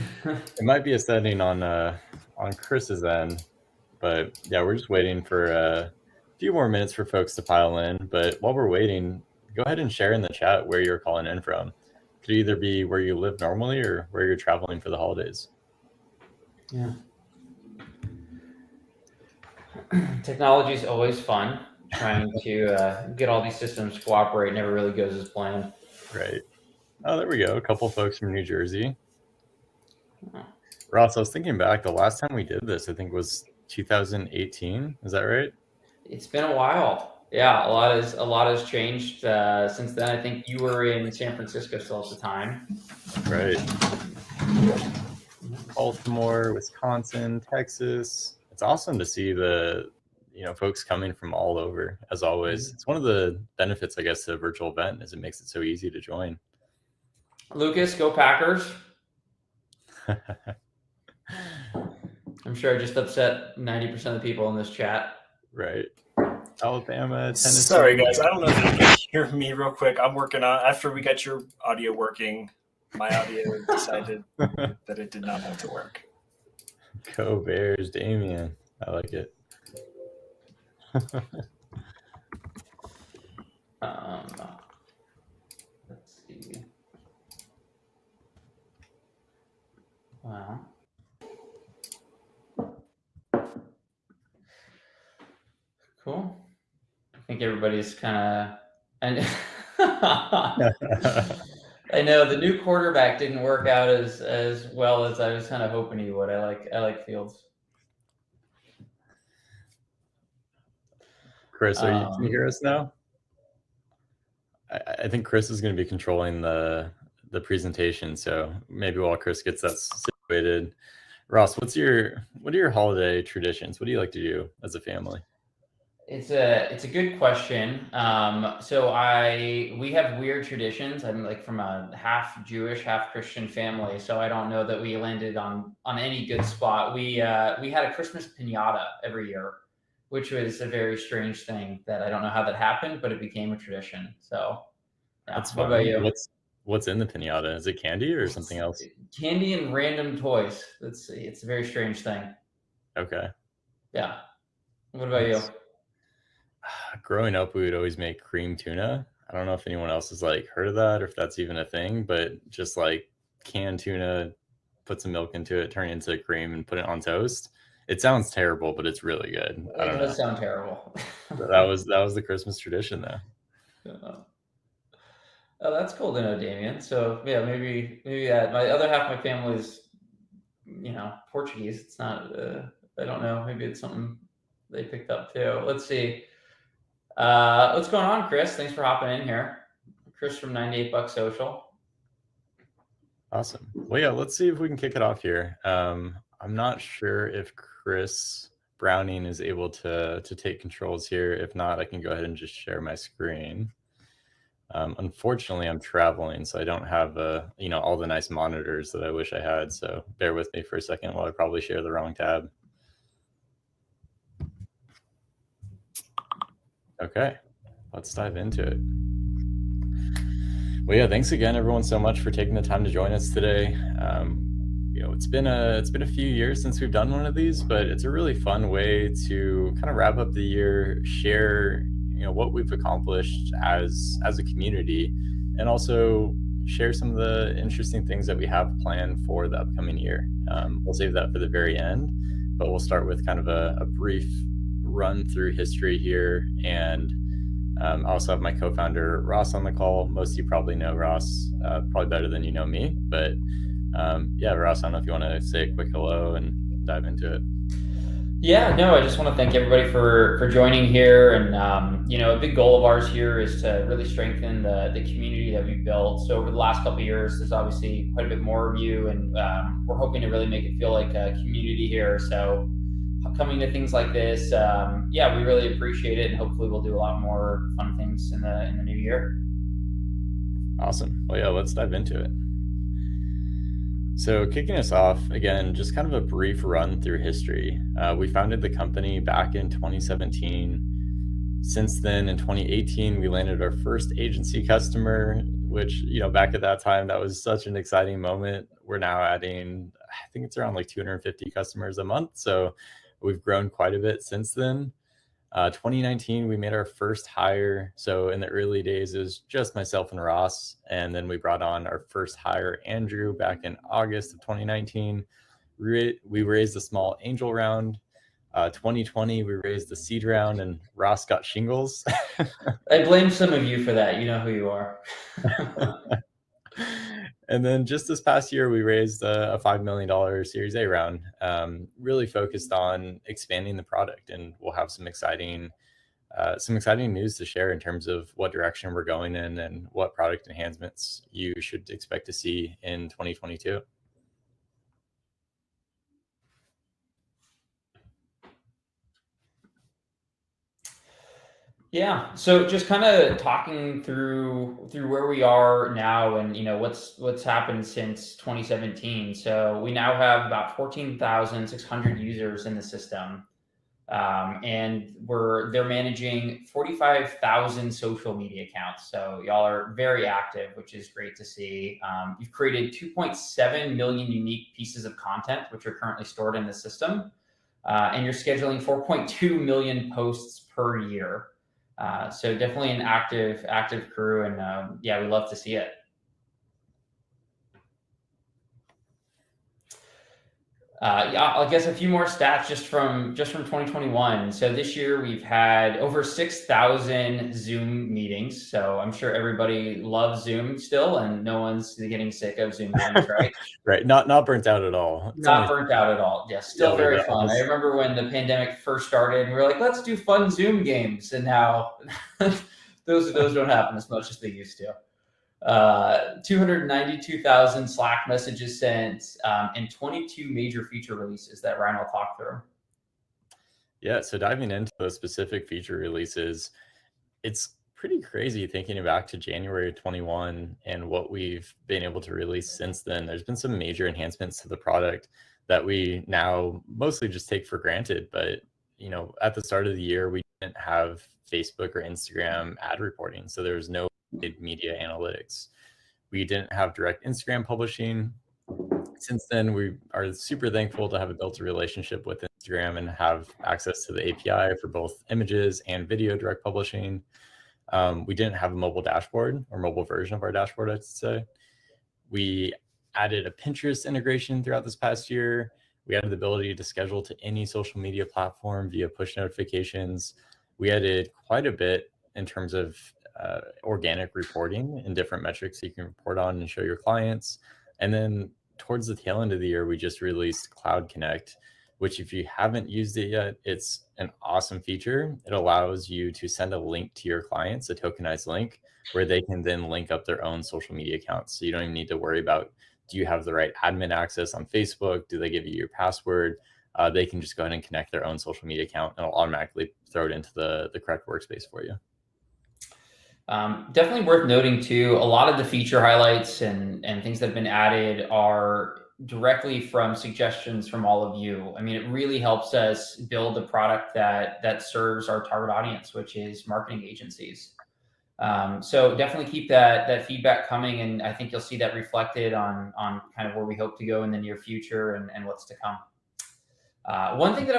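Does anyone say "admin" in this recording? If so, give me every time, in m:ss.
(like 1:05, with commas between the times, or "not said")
8:13.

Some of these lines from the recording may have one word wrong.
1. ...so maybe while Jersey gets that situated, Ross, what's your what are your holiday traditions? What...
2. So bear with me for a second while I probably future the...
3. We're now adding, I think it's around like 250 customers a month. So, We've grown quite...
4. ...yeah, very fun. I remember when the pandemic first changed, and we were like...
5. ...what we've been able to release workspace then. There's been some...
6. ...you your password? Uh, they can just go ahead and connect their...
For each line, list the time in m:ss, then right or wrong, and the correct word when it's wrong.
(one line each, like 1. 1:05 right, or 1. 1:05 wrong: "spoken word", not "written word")
1. 1:58 wrong: "Chris", not "Jersey"
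2. 3:29 wrong: "share", not "future"
3. 4:58 right
4. 6:46 wrong: "started", not "changed"
5. 7:11 wrong: "since", not "workspace"
6. 8:15 right.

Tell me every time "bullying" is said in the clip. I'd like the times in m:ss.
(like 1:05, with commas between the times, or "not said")
not said.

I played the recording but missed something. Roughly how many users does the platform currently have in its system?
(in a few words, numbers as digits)
14,600.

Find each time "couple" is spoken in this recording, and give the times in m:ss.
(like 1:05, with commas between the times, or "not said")
0:27, 4:26.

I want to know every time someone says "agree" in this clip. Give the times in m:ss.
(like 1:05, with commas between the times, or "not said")
not said.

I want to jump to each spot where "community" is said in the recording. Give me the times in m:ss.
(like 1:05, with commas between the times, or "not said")
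3:54, 4:25, 4:31.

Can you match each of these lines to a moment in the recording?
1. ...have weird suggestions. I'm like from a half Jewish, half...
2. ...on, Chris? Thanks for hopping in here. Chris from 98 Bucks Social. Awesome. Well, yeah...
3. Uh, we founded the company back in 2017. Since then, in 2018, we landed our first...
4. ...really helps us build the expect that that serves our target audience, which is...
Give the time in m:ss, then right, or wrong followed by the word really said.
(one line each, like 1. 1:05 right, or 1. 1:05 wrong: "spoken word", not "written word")
1. 2:09 wrong: "traditions", not "suggestions"
2. 3:08 right
3. 4:47 right
4. 8:32 wrong: "product", not "expect".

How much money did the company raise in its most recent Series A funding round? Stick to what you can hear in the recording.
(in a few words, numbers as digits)
$5 million.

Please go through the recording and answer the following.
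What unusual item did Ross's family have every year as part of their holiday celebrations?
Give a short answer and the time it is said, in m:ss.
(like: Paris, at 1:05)
Christmas pinata, at 2:17.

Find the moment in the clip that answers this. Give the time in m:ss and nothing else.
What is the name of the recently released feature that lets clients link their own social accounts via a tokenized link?
8:00.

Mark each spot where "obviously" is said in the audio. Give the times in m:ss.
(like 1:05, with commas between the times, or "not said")
4:27.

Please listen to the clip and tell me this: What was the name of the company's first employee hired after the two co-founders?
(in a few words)
Andrew.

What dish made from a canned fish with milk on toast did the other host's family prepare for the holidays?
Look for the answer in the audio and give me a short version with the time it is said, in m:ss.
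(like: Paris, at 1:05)
cream tuna, at 2:38.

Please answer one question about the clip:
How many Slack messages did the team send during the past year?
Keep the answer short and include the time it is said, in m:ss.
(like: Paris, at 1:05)
292,000, at 6:56.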